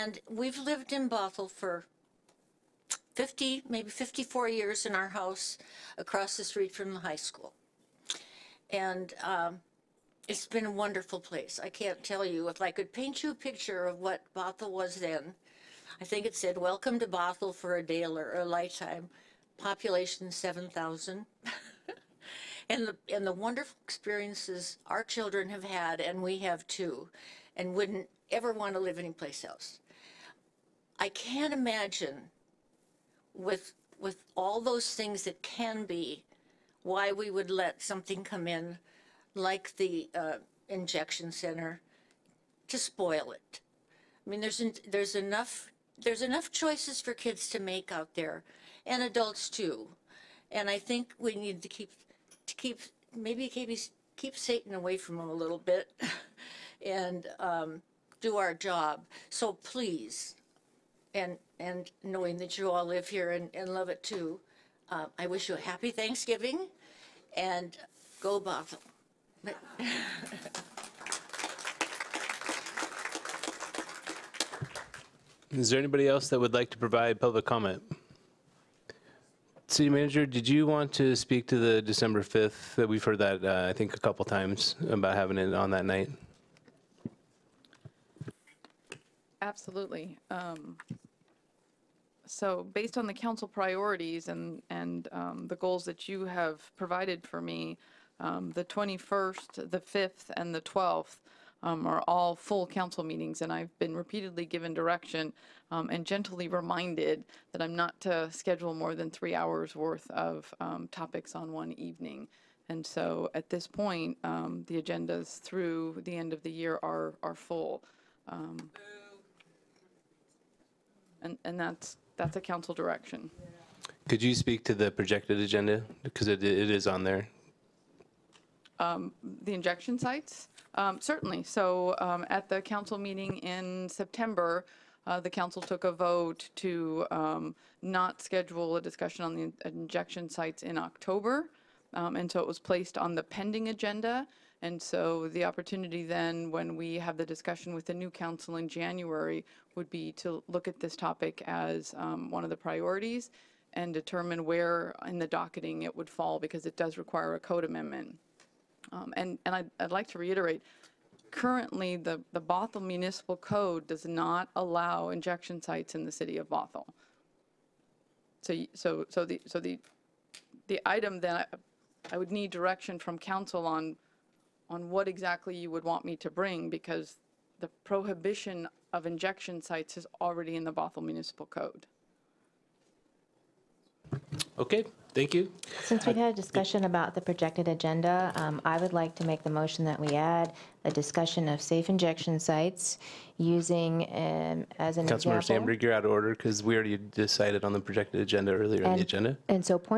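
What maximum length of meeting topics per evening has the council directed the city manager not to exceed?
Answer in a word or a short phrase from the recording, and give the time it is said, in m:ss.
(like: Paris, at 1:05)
3 hours, at 1:49.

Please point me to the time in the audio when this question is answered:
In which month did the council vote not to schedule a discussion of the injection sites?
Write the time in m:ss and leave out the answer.
2:20.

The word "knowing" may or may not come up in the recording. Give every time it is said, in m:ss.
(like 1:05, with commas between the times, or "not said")
1:02.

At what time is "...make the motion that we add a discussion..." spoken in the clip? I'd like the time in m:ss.
3:09.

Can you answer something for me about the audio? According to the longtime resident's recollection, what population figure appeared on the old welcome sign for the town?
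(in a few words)
7,000.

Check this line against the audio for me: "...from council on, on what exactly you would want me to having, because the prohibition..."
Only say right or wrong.
wrong.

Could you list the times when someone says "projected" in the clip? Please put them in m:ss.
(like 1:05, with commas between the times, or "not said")
2:04, 3:07, 3:17.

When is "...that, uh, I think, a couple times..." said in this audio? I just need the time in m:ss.
1:23.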